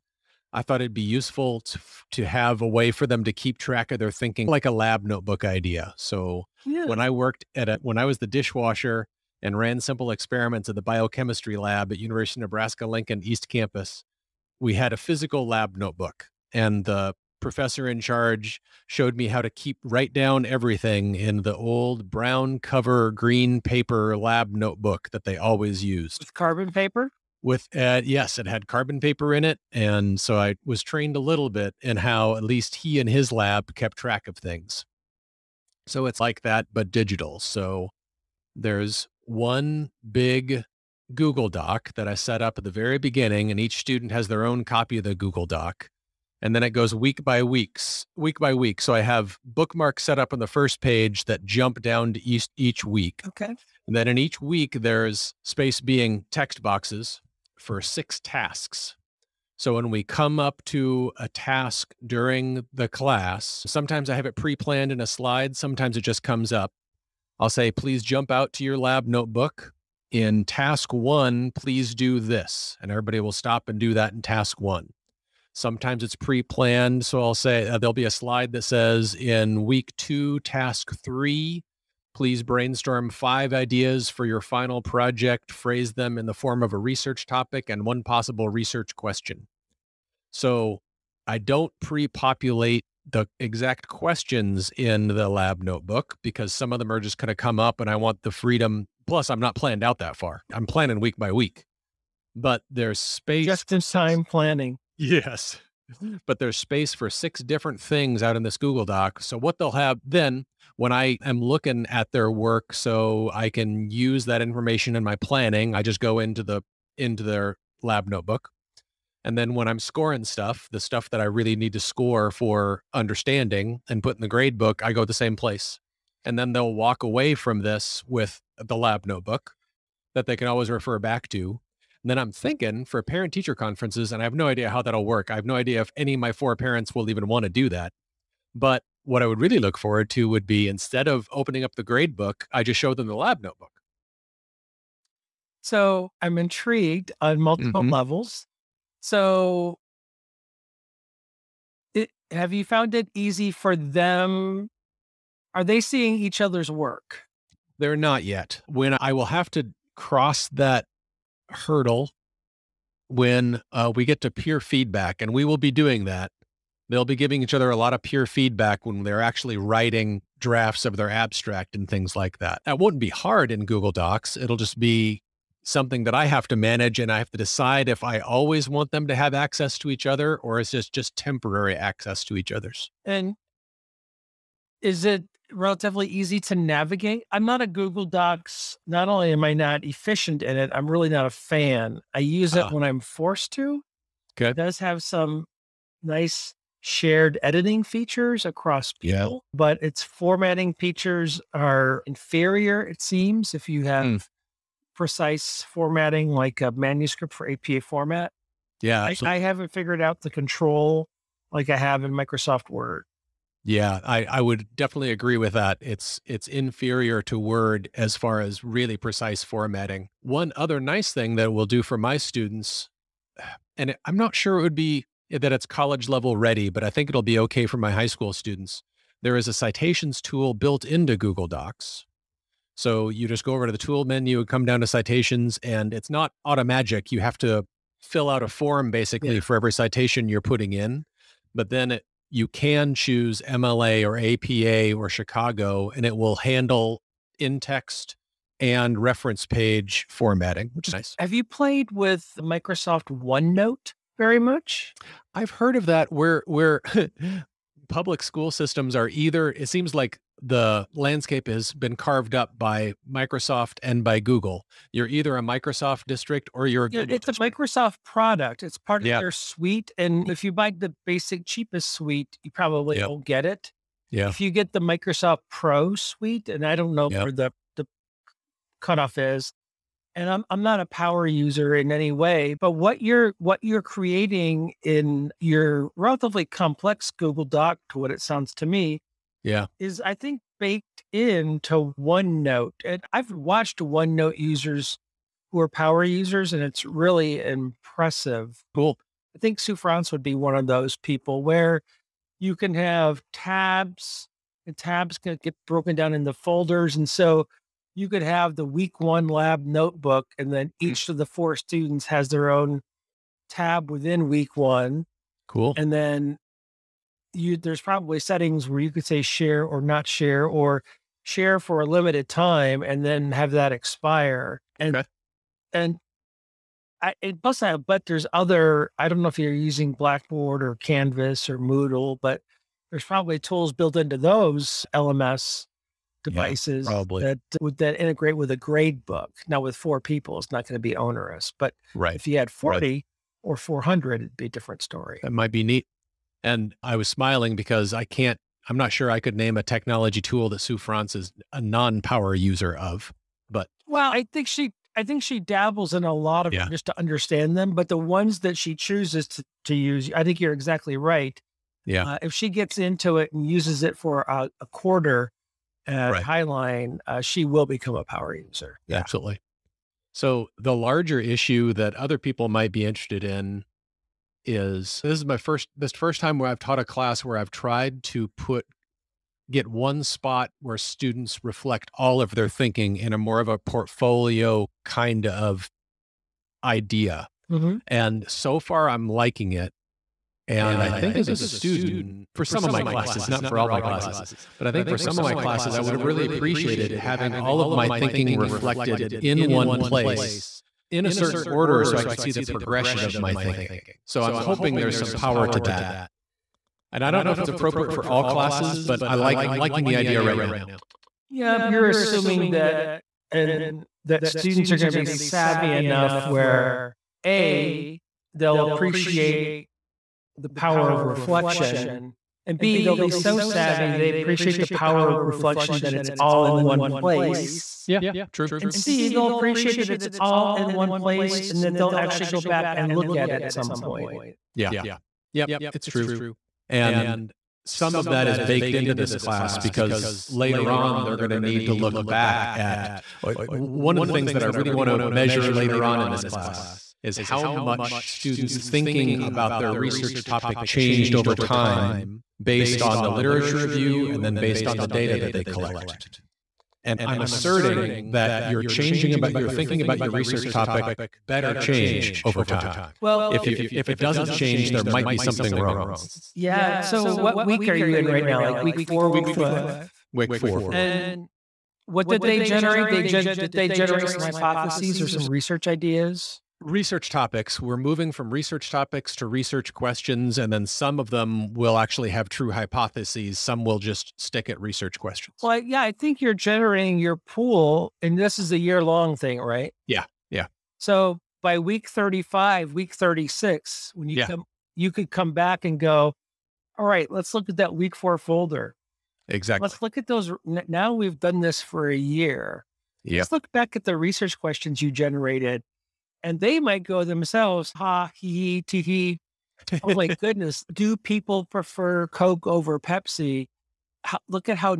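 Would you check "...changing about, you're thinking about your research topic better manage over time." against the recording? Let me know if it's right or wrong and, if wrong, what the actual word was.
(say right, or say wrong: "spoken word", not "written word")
wrong: "change", not "manage".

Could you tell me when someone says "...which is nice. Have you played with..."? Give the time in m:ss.
4:10.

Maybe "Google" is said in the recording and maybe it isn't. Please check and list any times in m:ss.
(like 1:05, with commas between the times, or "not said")
0:41, 0:45, 1:48, 2:53, 3:07, 3:51, 4:24, 4:47.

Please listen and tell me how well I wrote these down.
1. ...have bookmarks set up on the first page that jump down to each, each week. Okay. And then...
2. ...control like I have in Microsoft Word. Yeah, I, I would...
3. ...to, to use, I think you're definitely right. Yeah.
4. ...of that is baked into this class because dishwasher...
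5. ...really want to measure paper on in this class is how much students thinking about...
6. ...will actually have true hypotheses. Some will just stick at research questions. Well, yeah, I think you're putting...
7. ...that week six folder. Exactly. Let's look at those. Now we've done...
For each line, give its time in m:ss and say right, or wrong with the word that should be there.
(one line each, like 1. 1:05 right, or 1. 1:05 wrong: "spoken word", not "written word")
1. 0:49 right
2. 3:30 right
3. 5:59 wrong: "exactly", not "definitely"
4. 7:17 wrong: "later", not "dishwasher"
5. 7:24 wrong: "later", not "paper"
6. 8:01 wrong: "generating", not "putting"
7. 8:17 wrong: "four", not "six".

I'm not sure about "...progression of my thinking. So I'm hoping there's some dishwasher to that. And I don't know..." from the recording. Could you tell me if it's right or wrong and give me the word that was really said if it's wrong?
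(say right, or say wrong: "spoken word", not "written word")
wrong: "power", not "dishwasher".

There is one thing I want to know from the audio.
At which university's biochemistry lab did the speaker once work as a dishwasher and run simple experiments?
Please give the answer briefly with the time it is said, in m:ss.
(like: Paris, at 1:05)
University of Nebraska Lincoln, at 0:11.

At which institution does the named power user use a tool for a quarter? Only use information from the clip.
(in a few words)
Highline.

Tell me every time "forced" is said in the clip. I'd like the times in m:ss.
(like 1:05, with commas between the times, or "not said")
3:13.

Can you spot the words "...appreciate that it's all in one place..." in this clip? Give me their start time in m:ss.
7:09.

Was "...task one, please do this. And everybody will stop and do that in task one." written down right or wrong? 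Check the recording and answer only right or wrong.
right.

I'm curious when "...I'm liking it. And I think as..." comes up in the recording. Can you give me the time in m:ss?
6:28.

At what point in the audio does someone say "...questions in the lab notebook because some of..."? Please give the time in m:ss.
1:33.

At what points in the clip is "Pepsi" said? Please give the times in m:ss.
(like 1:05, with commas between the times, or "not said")
8:32.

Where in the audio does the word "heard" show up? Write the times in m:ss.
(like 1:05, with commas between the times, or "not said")
4:15.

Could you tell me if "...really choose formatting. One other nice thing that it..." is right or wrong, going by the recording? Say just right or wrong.
wrong.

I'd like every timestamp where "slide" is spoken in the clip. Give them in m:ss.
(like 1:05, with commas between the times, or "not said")
1:05, 1:18.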